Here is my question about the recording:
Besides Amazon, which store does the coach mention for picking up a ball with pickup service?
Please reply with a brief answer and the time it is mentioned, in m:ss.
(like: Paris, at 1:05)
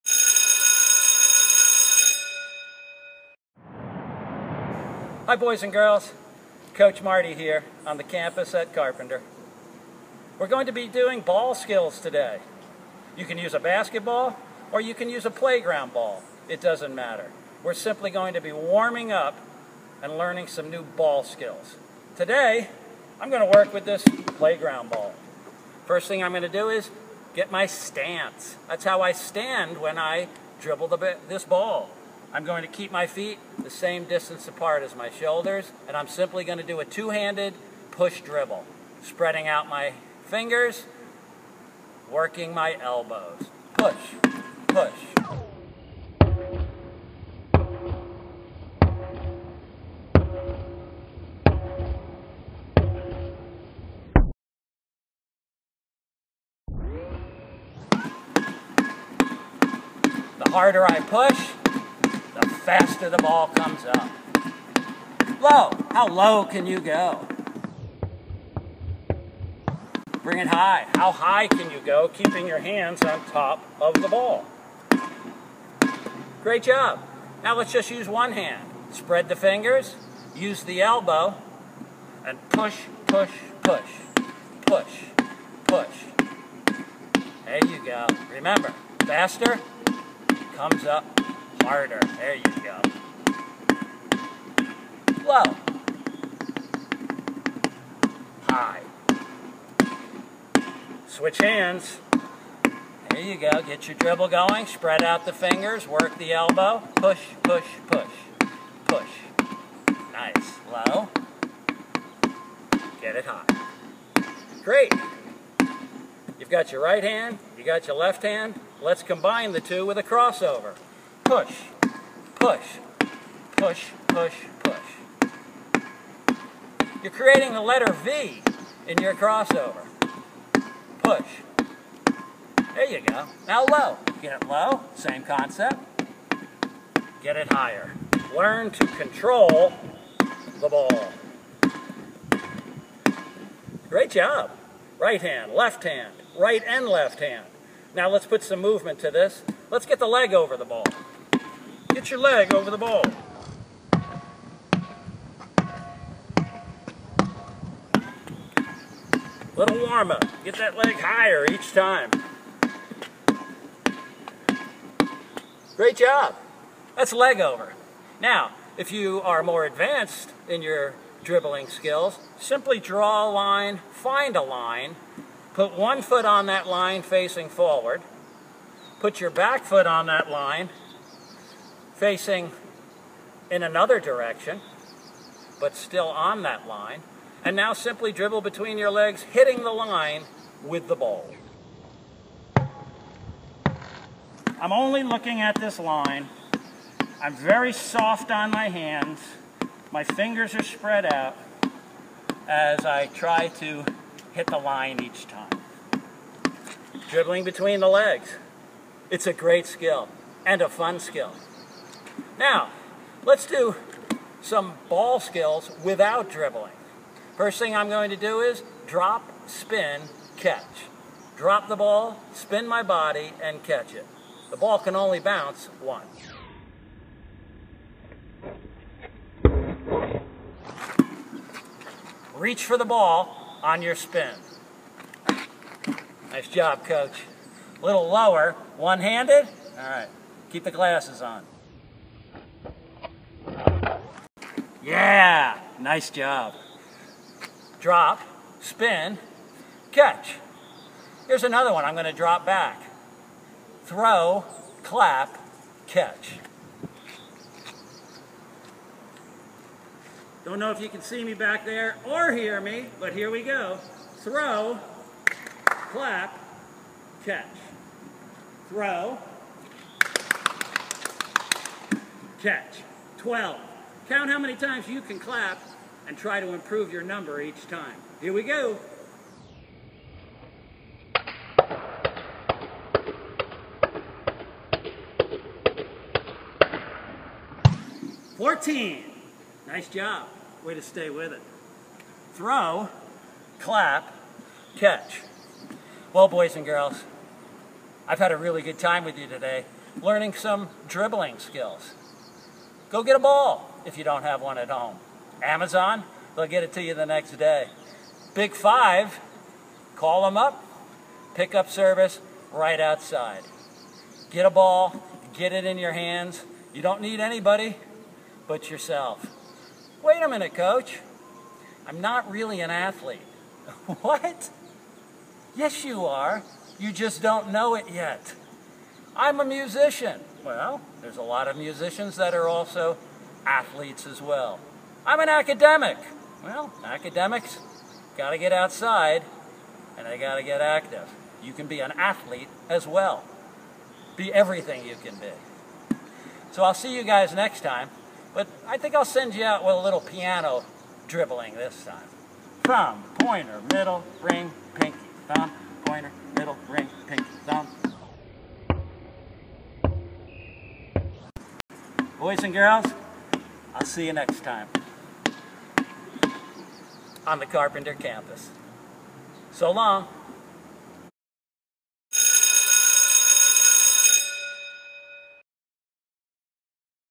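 Big Five, at 5:08.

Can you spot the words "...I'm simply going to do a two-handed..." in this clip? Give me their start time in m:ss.
0:35.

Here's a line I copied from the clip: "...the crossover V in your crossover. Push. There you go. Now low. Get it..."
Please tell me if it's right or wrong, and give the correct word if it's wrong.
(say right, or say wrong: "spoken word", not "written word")
wrong: "letter", not "crossover".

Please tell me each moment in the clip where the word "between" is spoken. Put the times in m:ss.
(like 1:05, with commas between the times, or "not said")
3:08, 3:27.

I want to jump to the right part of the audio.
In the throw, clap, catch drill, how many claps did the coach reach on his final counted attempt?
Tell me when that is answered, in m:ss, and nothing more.
4:48.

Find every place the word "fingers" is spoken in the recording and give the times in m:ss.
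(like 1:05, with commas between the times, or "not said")
0:40, 1:19, 1:45, 3:20.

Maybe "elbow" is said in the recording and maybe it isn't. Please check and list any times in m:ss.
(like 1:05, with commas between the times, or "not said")
0:42, 1:20, 1:46.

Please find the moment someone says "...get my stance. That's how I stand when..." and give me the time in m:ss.
0:27.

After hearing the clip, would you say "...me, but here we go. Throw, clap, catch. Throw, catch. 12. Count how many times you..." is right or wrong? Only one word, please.
right.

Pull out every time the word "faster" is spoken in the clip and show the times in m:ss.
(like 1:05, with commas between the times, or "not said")
1:02, 1:29.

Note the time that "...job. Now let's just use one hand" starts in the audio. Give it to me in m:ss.
1:16.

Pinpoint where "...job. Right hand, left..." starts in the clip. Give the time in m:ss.
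2:24.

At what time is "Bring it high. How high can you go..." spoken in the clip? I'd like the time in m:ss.
1:10.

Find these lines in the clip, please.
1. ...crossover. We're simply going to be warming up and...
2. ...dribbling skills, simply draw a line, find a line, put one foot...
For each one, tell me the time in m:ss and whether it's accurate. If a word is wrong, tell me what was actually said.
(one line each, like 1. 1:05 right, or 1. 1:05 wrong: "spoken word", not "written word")
1. 0:16 wrong: "matter", not "crossover"
2. 2:51 right.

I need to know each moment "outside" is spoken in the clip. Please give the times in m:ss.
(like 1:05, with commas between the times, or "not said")
5:12, 5:38.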